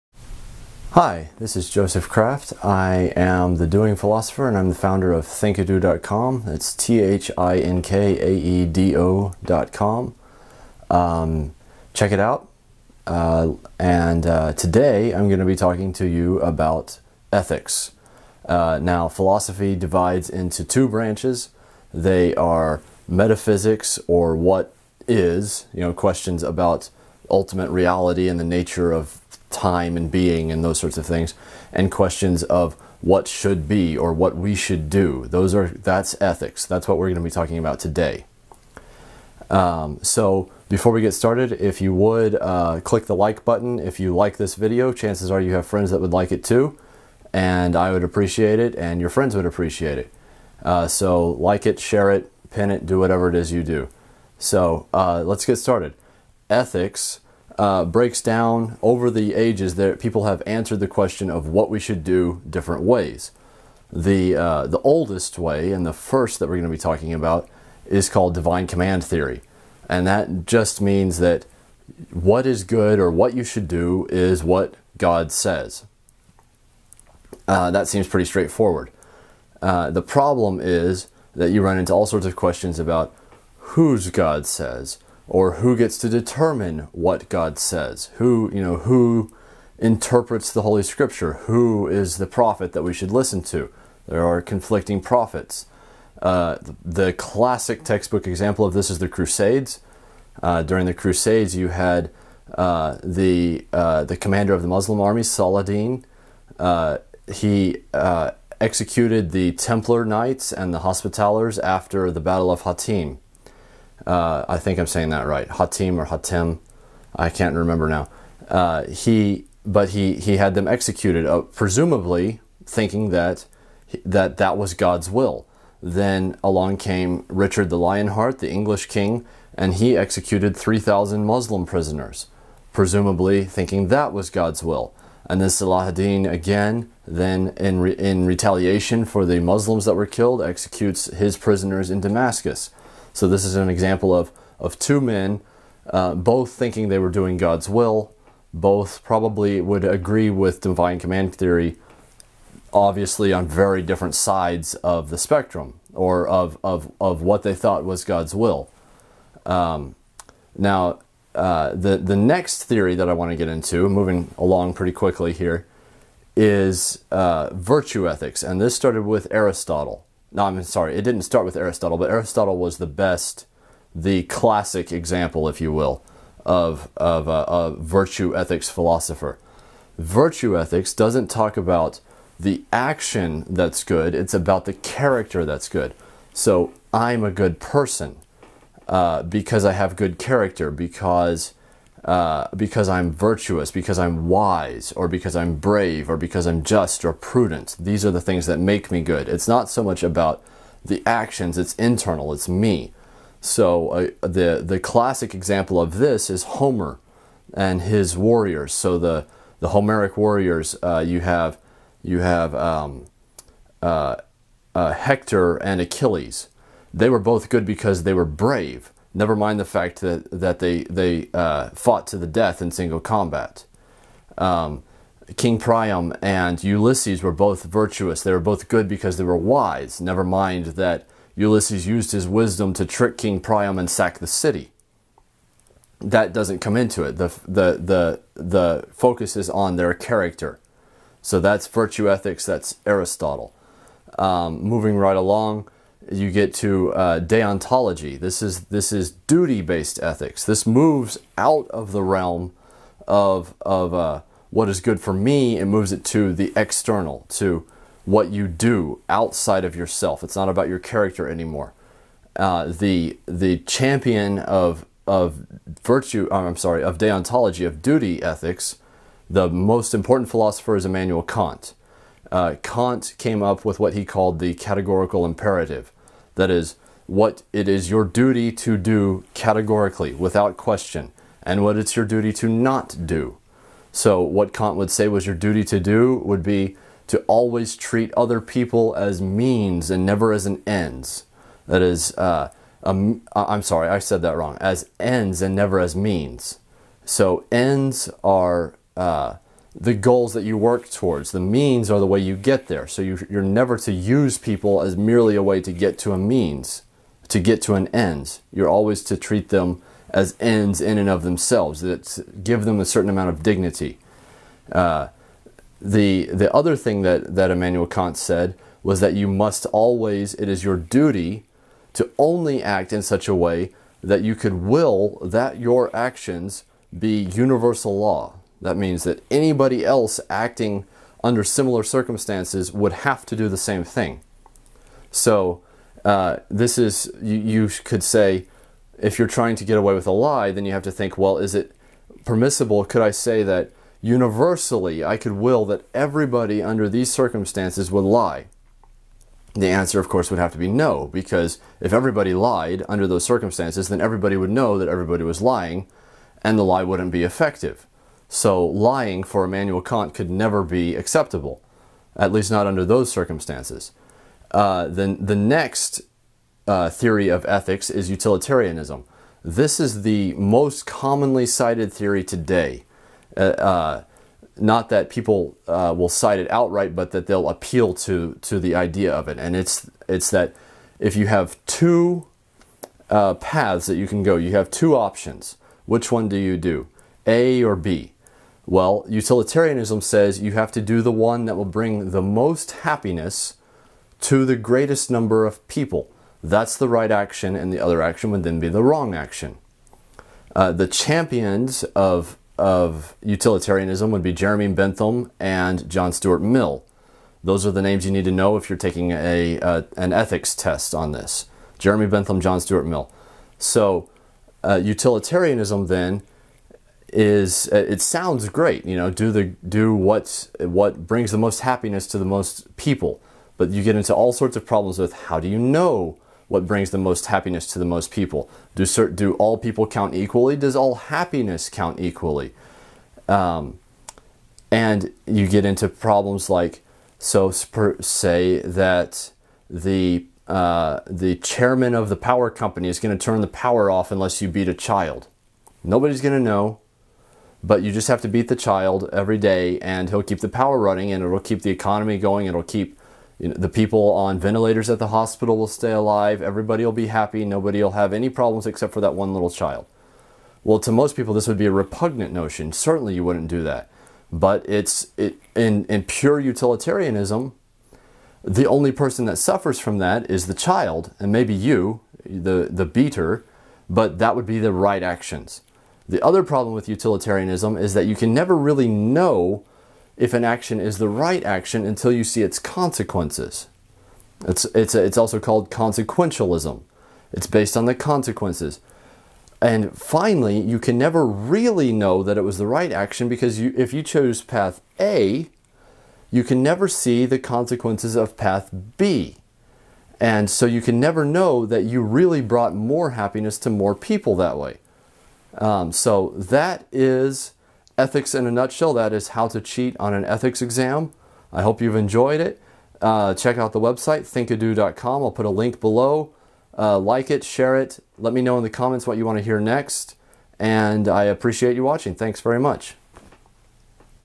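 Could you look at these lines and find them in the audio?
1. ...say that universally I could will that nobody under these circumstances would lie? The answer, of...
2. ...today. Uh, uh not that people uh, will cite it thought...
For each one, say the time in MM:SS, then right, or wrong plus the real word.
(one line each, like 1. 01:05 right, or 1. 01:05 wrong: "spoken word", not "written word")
1. 05:43 wrong: "everybody", not "nobody"
2. 06:12 wrong: "outright", not "thought".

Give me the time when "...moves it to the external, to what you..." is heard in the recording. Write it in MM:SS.
04:15.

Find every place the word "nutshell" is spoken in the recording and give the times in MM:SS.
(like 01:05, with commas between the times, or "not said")
08:28.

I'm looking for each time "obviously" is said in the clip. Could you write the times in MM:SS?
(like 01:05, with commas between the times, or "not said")
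02:32.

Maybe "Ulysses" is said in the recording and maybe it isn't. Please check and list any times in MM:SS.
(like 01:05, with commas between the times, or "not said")
03:46, 03:51.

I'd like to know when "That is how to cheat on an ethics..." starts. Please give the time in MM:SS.
08:28.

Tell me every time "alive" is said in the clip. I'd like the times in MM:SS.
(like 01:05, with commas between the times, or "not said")
07:35.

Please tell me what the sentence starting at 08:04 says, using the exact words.
It's, it's, it's also called consequentialism.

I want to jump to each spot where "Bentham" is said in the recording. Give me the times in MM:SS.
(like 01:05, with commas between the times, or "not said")
06:44, 06:52.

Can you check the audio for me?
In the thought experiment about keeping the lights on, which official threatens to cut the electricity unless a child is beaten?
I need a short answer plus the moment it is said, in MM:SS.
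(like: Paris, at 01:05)
chairman of the power company, at 07:21.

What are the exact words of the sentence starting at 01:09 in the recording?
And that just means that what is good or what you should do is what God says.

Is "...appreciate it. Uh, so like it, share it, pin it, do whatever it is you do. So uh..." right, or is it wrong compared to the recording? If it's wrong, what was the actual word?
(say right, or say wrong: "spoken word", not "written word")
right.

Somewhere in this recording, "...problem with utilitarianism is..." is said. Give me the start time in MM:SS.
07:56.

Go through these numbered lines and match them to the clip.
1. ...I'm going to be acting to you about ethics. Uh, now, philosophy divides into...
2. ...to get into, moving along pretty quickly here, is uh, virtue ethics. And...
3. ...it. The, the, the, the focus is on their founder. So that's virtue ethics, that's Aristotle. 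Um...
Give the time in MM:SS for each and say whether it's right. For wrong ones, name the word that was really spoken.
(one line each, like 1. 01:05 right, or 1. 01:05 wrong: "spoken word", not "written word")
1. 00:15 wrong: "talking", not "acting"
2. 02:43 right
3. 03:57 wrong: "character", not "founder".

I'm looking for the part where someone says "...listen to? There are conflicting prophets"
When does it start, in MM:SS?
01:33.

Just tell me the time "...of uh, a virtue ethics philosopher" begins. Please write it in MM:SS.
02:56.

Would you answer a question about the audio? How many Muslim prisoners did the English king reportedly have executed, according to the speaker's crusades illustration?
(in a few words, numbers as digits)
3,000.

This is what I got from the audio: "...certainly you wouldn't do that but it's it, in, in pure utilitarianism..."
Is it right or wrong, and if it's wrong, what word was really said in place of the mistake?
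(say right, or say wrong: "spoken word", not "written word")
right.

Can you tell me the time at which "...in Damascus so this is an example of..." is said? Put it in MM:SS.
02:21.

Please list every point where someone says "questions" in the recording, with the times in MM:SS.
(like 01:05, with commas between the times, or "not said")
00:25, 00:31, 01:00, 01:22, 04:40.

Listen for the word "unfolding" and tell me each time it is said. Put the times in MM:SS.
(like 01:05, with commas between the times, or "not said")
not said.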